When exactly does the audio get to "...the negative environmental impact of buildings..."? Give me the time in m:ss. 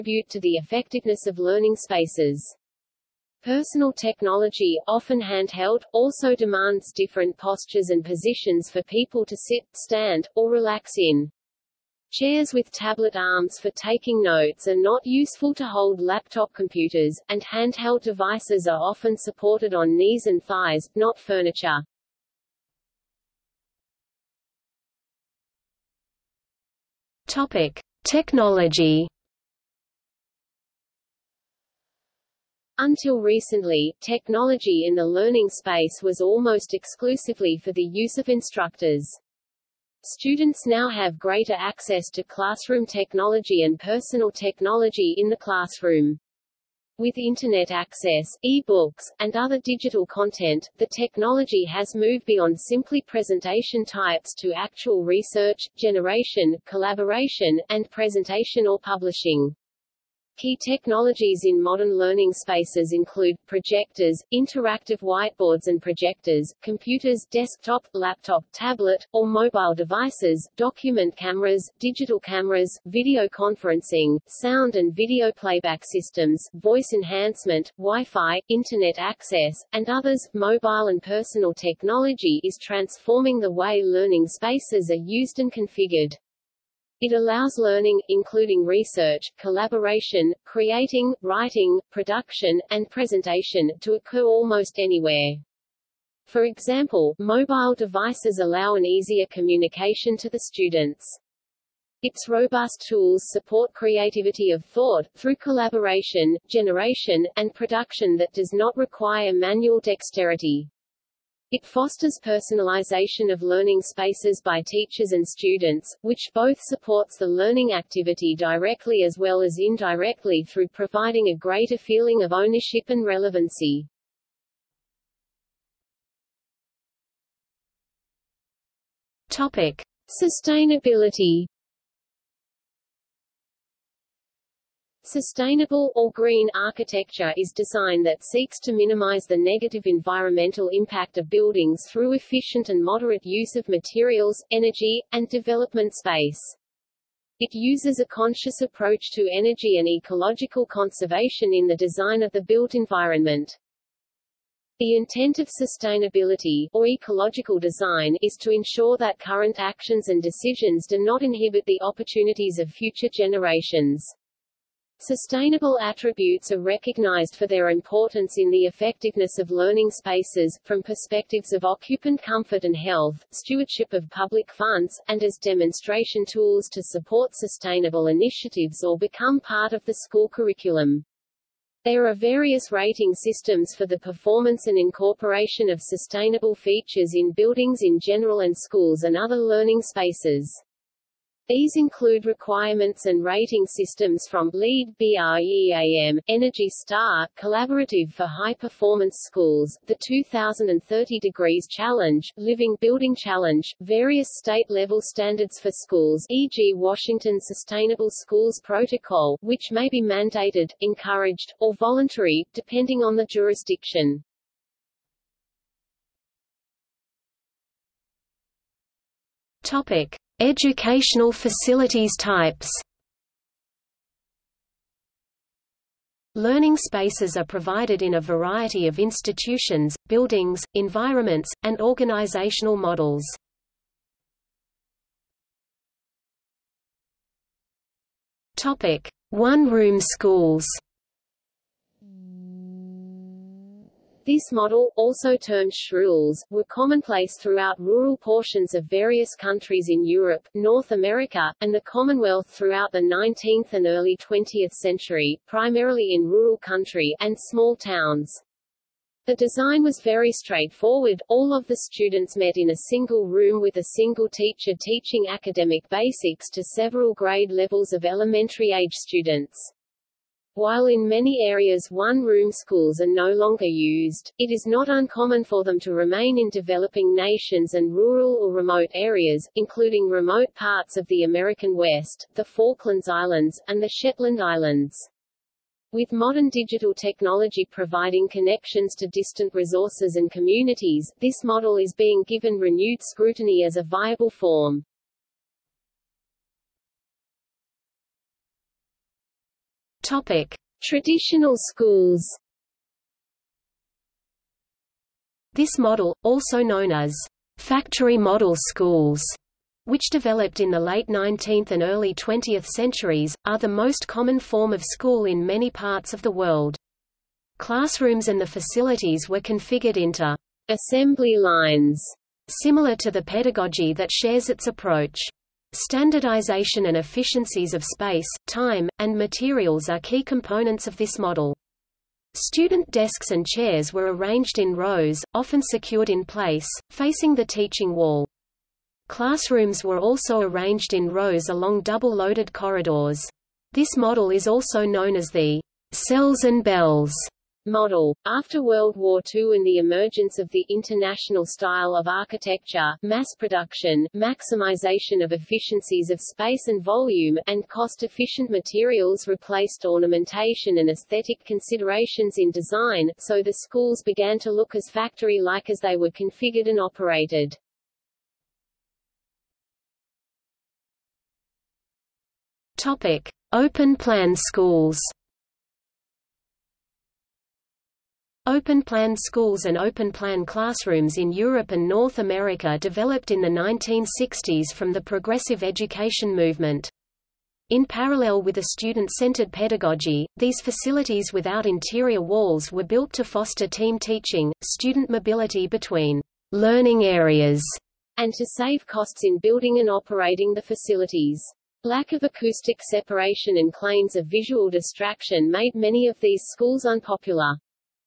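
2:19.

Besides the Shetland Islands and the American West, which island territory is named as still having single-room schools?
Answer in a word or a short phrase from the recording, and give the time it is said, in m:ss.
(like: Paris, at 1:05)
Falklands Islands, at 4:42.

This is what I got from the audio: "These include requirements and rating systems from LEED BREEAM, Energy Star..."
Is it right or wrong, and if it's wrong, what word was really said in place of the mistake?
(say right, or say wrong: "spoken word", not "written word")
right.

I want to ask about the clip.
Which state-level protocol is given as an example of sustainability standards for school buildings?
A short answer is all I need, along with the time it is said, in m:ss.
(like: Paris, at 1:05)
Washington Sustainable Schools Protocol, at 3:26.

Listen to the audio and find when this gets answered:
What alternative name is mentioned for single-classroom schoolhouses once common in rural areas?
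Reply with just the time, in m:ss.
4:05.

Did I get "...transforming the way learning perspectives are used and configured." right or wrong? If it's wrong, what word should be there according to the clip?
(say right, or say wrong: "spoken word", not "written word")
wrong: "spaces", not "perspectives".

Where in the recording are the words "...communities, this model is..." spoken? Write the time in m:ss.
4:50.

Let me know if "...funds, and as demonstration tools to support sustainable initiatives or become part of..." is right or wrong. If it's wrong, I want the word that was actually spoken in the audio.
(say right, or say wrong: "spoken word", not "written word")
right.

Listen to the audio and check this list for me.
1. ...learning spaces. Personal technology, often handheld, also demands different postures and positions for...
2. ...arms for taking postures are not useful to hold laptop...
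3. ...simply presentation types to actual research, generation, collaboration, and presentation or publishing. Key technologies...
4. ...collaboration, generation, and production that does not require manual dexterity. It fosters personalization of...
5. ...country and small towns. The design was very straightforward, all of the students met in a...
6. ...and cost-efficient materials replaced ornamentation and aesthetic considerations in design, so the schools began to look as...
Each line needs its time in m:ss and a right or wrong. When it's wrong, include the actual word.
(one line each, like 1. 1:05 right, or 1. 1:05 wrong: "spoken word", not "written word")
1. 0:01 right
2. 0:13 wrong: "notes", not "postures"
3. 0:52 right
4. 1:45 right
5. 4:16 right
6. 5:57 right.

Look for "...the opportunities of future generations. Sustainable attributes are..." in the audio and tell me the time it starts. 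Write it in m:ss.
2:41.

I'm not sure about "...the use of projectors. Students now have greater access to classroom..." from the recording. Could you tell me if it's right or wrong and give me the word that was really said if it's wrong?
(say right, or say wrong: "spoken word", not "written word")
wrong: "instructors", not "projectors".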